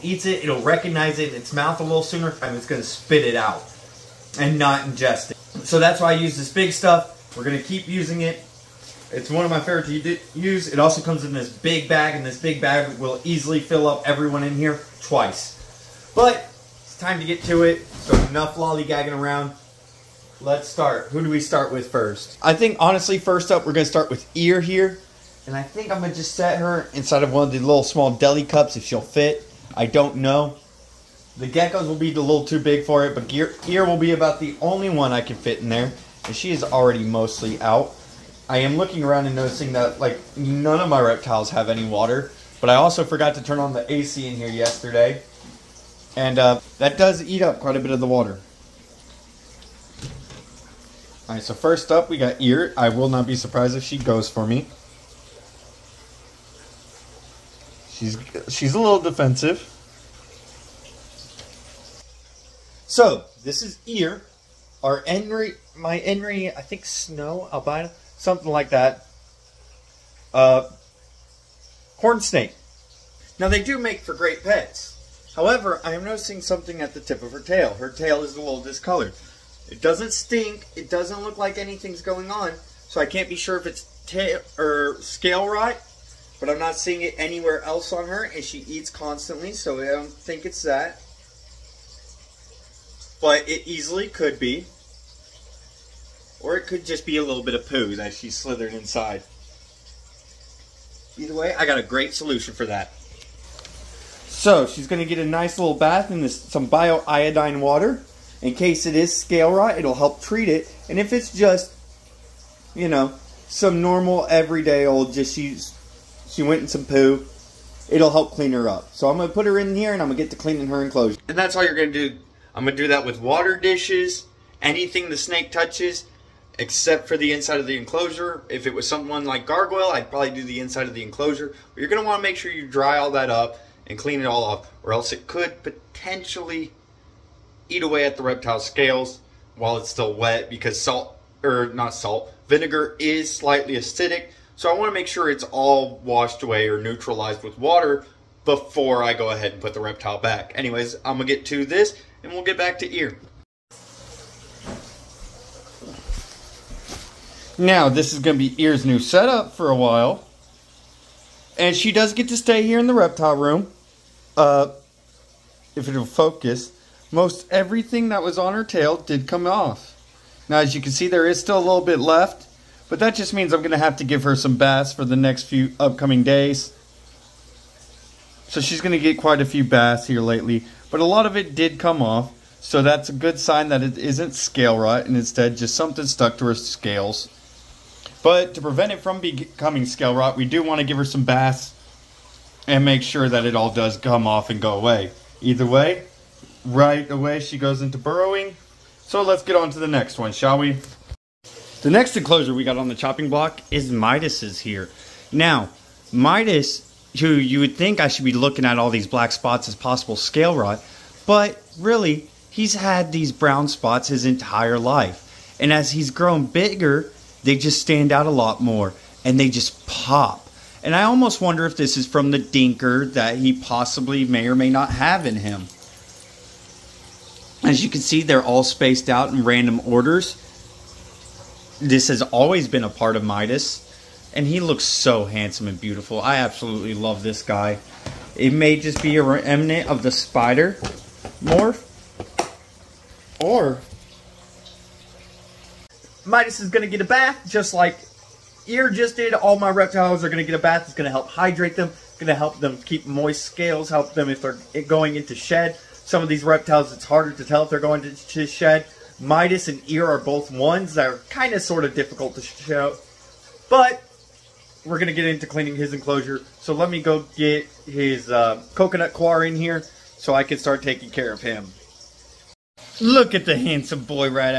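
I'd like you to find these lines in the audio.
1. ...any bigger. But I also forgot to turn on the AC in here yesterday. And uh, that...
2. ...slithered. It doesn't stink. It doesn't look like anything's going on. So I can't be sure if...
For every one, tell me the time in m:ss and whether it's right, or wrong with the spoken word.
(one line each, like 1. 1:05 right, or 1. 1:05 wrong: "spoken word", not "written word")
1. 0:41 wrong: "water", not "bigger"
2. 1:18 wrong: "discolored", not "slithered".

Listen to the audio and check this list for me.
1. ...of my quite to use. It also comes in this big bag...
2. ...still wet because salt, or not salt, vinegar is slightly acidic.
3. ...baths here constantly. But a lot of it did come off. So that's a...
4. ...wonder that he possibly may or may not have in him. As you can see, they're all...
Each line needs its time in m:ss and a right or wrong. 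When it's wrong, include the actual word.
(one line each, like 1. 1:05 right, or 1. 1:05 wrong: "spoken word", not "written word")
1. 0:09 wrong: "favorite", not "quite"
2. 2:19 right
3. 2:59 wrong: "lately", not "constantly"
4. 3:42 wrong: "dinker", not "wonder".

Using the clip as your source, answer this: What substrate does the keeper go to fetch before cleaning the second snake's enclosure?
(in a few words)
coconut coir.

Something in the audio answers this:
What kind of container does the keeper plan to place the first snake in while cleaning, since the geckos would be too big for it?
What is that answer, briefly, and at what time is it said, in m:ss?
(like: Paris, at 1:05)
small deli cups, at 0:27.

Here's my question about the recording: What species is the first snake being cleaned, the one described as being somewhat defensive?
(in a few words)
corn snake.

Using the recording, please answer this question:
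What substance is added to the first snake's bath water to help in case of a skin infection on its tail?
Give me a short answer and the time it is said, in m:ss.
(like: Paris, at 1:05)
bioiodine, at 1:46.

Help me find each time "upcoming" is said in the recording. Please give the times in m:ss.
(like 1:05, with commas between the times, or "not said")
2:55.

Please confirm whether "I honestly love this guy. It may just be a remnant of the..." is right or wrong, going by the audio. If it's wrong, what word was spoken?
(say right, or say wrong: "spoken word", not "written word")
wrong: "absolutely", not "honestly".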